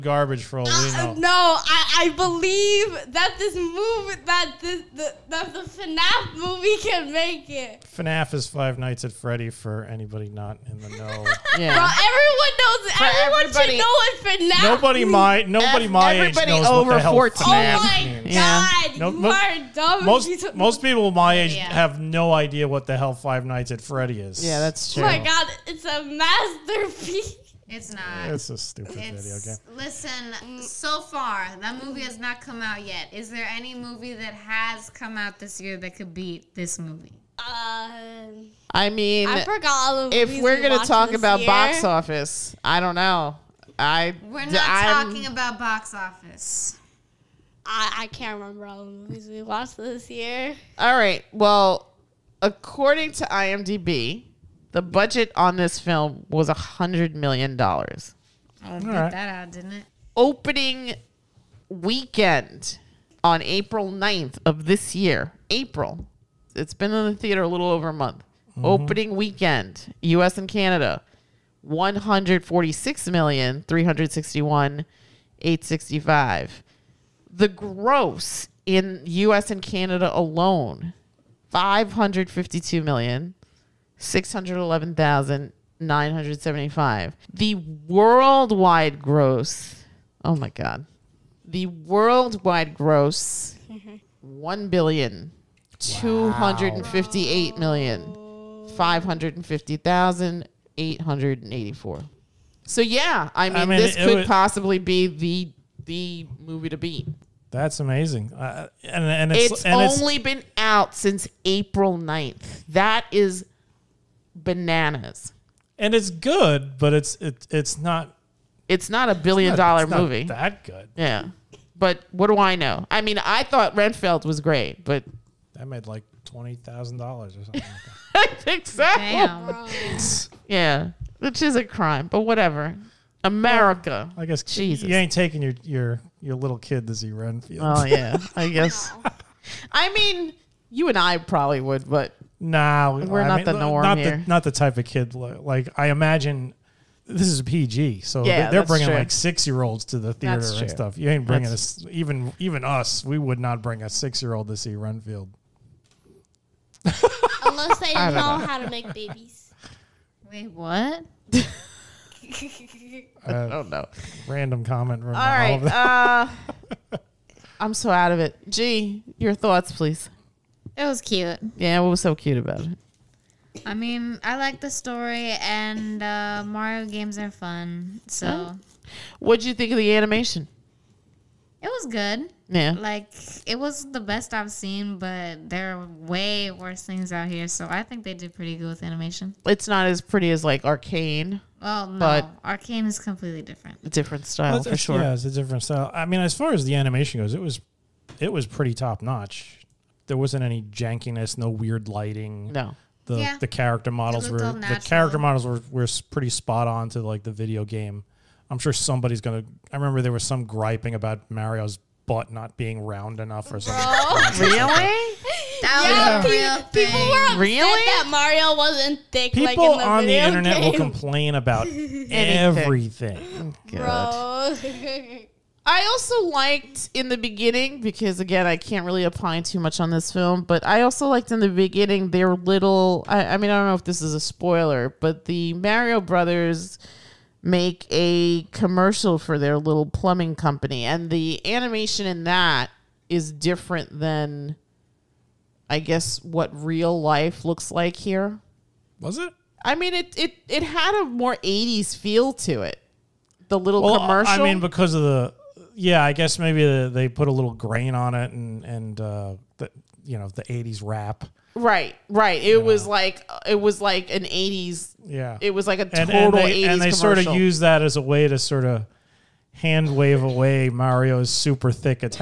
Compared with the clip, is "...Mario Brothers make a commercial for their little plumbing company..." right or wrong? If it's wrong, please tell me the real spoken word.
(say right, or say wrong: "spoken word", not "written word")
right.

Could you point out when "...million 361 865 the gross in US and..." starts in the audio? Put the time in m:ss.
1:13.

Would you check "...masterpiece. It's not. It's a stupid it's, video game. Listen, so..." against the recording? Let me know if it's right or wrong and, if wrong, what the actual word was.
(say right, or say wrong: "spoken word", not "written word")
right.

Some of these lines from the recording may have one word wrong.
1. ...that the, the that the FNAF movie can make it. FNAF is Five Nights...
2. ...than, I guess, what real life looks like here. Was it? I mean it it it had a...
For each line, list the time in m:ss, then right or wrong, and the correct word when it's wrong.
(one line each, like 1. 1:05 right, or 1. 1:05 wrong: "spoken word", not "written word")
1. 0:04 right
2. 4:04 right.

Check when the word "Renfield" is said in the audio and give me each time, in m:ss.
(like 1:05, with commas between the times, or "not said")
2:03, 2:17, 2:34.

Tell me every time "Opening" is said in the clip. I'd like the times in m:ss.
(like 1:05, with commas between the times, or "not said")
1:00, 1:08.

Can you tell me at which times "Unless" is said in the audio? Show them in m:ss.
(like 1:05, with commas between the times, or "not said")
2:36.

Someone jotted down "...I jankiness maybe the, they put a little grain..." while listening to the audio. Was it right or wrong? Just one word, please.
wrong.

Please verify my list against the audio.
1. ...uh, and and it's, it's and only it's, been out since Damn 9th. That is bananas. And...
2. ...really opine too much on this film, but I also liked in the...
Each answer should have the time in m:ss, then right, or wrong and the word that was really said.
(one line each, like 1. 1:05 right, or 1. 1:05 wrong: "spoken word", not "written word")
1. 1:48 wrong: "April", not "Damn"
2. 3:48 right.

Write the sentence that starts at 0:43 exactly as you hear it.
I we're not I'm, talking about box office.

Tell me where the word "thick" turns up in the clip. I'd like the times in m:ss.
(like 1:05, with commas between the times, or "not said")
3:39, 4:31.